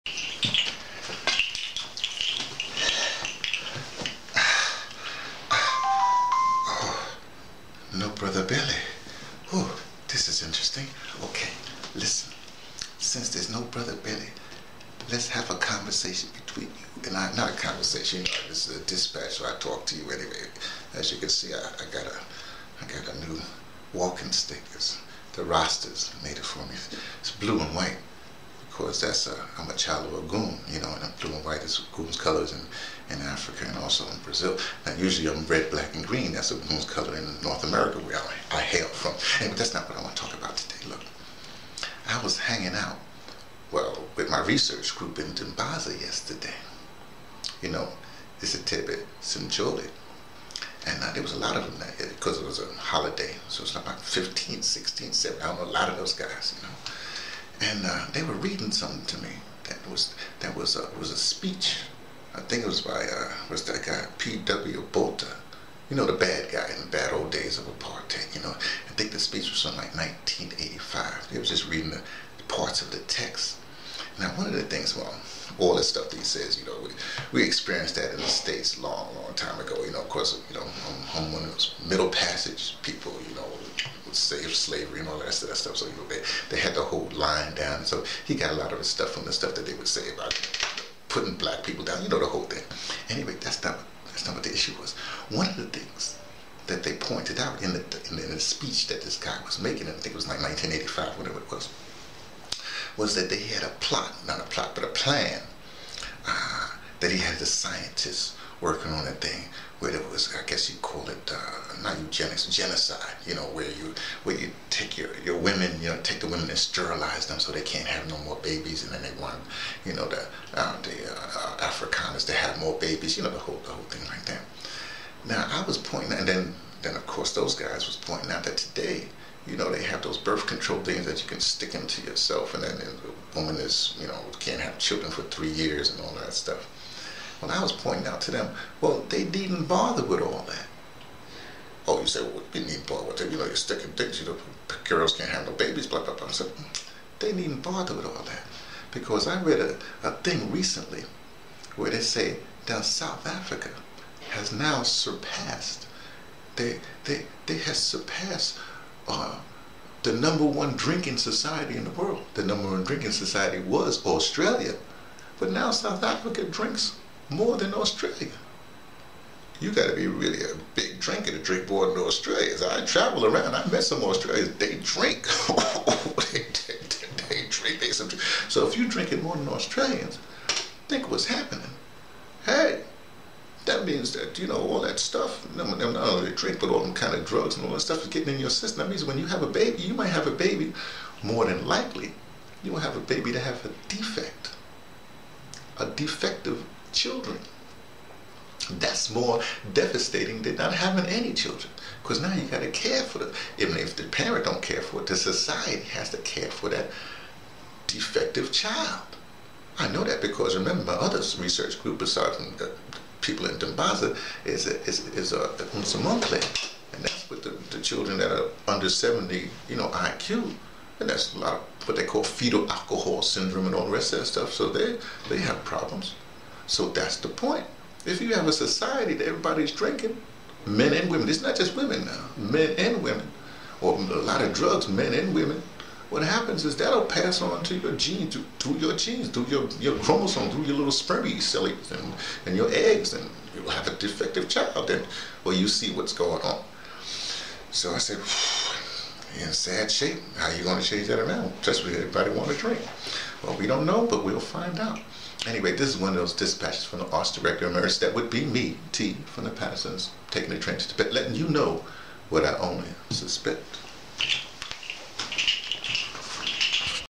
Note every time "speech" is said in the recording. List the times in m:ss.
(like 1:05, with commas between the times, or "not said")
1:01, 1:09, 1:38.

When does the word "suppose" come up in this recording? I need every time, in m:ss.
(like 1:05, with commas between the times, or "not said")
not said.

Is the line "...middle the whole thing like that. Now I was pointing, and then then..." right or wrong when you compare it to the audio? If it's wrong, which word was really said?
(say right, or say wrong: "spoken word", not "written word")
wrong: "whole", not "middle".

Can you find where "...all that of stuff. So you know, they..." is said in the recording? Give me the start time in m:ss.
1:25.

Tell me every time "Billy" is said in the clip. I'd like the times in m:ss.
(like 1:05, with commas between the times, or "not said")
0:08, 0:13.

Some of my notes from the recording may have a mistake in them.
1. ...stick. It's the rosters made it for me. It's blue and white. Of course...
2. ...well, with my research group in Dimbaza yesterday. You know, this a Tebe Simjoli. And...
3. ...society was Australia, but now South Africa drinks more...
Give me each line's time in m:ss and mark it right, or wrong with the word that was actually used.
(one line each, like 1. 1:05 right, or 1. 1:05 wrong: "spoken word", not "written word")
1. 0:24 right
2. 0:43 right
3. 2:43 right.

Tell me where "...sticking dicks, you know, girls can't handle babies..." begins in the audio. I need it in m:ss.
2:23.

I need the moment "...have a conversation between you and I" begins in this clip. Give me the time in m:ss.
0:15.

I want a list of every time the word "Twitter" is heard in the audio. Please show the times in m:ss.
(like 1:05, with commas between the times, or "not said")
not said.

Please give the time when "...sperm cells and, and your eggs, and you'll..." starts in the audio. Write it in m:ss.
4:00.